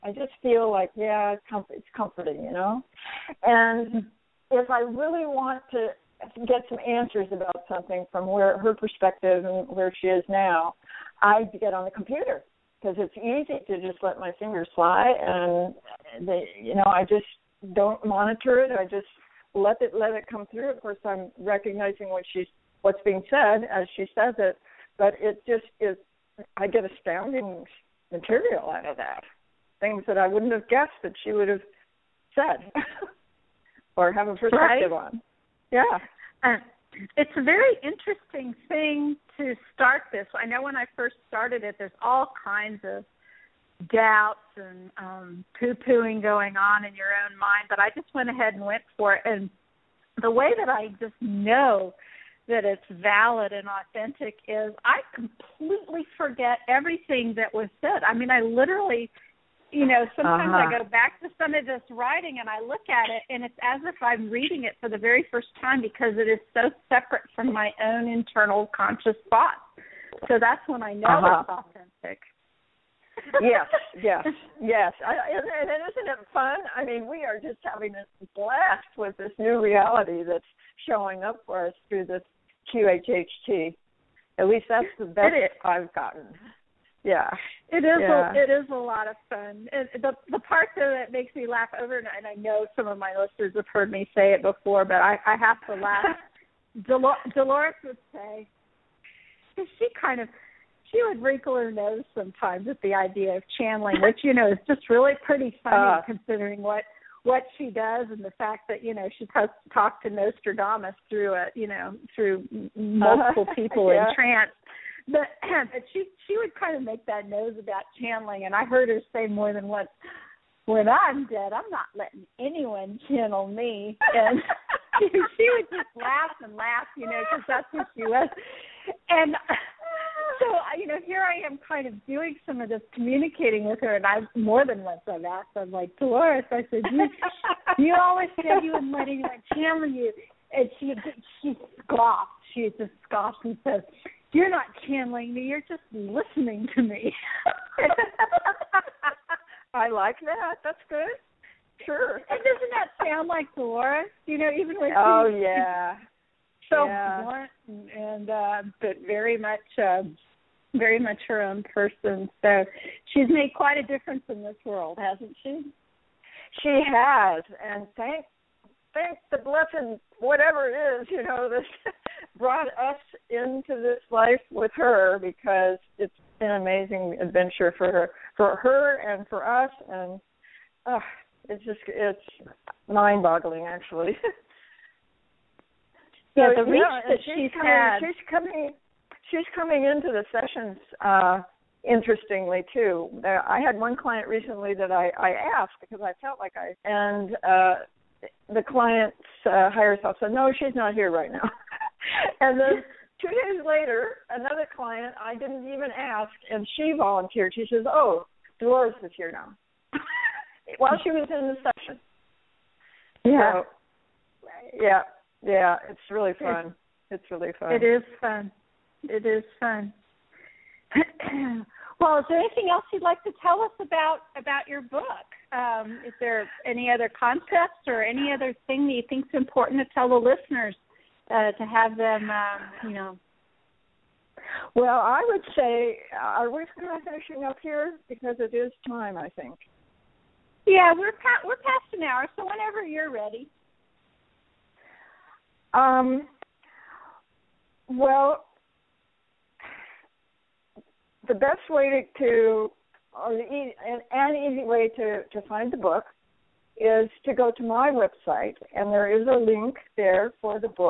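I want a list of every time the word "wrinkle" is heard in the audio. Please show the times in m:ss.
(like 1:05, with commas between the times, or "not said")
1:41.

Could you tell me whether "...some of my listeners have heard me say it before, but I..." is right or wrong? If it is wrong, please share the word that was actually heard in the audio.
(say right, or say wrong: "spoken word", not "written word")
right.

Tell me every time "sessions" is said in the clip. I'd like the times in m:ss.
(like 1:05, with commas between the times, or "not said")
3:10, 3:31.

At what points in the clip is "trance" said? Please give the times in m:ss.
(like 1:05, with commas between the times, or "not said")
1:54.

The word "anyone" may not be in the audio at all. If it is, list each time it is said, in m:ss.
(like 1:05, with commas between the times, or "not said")
2:02, 2:19.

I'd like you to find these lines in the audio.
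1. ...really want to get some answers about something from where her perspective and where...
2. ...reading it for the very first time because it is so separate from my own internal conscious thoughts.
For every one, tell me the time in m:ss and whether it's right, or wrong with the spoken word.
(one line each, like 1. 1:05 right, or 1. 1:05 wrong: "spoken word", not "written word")
1. 0:04 right
2. 1:04 right.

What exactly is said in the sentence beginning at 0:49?
And the way that I just know that it's valid and authentic is I completely forget everything that was said.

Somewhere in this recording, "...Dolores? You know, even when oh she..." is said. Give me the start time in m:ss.
2:33.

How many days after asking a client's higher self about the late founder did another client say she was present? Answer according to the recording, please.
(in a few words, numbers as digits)
2.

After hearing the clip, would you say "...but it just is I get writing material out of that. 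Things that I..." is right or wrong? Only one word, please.
wrong.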